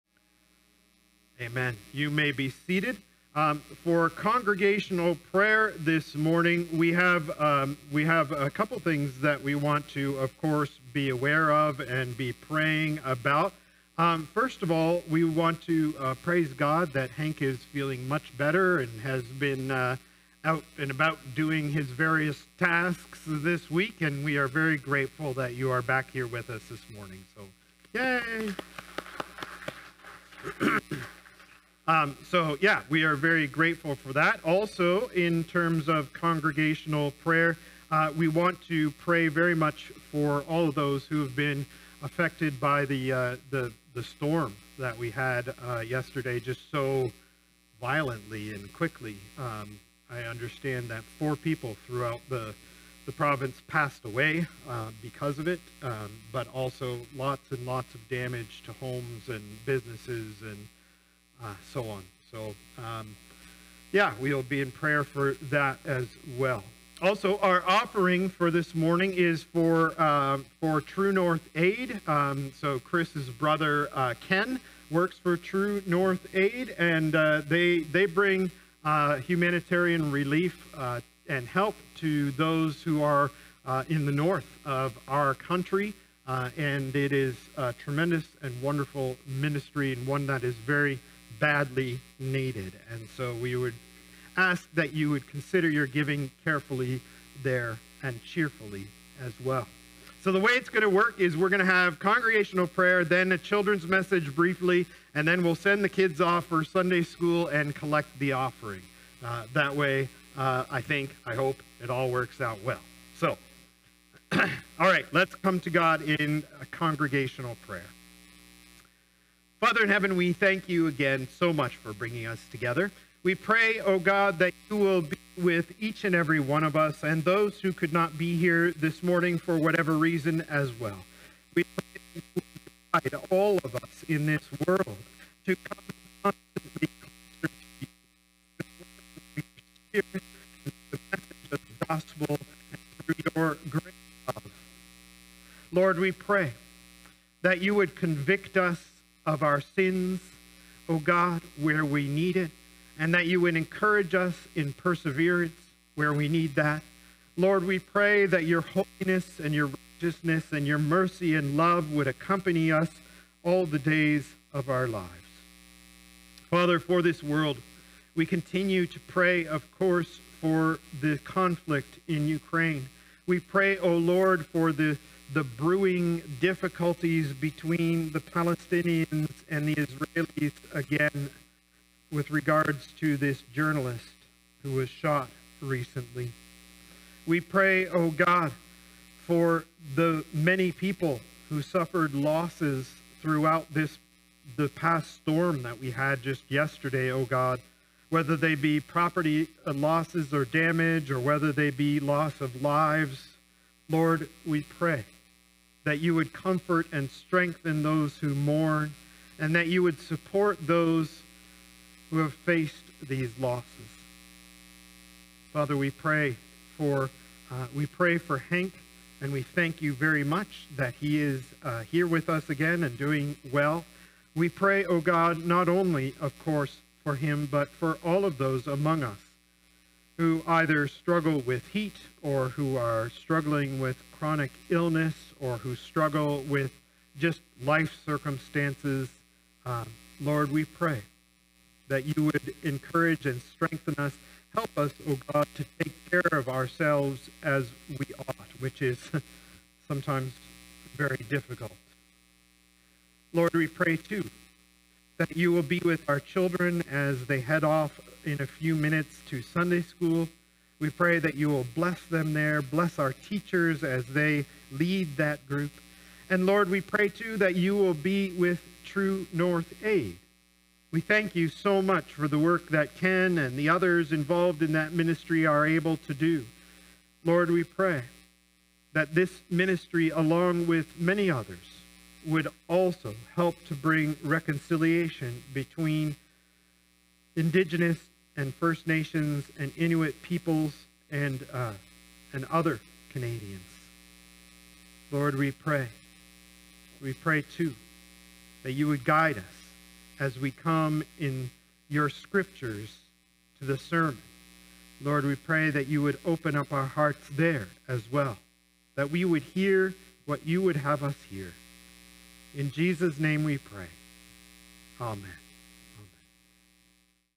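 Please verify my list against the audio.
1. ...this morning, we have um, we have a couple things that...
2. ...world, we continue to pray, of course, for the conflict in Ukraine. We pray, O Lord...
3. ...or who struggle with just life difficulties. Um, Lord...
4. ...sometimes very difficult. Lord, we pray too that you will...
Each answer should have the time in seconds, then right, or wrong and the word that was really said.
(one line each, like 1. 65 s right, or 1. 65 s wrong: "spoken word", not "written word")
1. 5 s right
2. 167 s right
3. 235 s wrong: "circumstances", not "difficulties"
4. 249 s right.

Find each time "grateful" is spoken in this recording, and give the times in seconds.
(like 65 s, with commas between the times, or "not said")
24 s, 33 s.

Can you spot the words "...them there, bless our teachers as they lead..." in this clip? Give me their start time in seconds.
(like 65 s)
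262 s.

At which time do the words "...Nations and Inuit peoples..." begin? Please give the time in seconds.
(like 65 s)
288 s.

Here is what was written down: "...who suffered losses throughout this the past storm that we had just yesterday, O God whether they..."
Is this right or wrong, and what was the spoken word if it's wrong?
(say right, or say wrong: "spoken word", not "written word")
right.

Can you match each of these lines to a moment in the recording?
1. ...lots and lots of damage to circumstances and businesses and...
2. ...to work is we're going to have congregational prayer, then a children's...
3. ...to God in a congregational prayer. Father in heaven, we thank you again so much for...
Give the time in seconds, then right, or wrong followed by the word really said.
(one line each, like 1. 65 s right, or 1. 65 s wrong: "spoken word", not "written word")
1. 57 s wrong: "homes", not "circumstances"
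2. 100 s right
3. 115 s right.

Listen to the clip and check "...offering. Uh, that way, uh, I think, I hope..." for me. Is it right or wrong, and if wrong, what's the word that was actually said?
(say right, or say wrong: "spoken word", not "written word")
right.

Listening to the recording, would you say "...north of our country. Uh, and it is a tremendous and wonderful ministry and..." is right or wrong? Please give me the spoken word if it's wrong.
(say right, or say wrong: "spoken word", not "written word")
right.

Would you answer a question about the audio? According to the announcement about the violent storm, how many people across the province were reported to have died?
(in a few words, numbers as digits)
4.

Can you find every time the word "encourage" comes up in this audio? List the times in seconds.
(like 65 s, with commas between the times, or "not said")
153 s, 242 s.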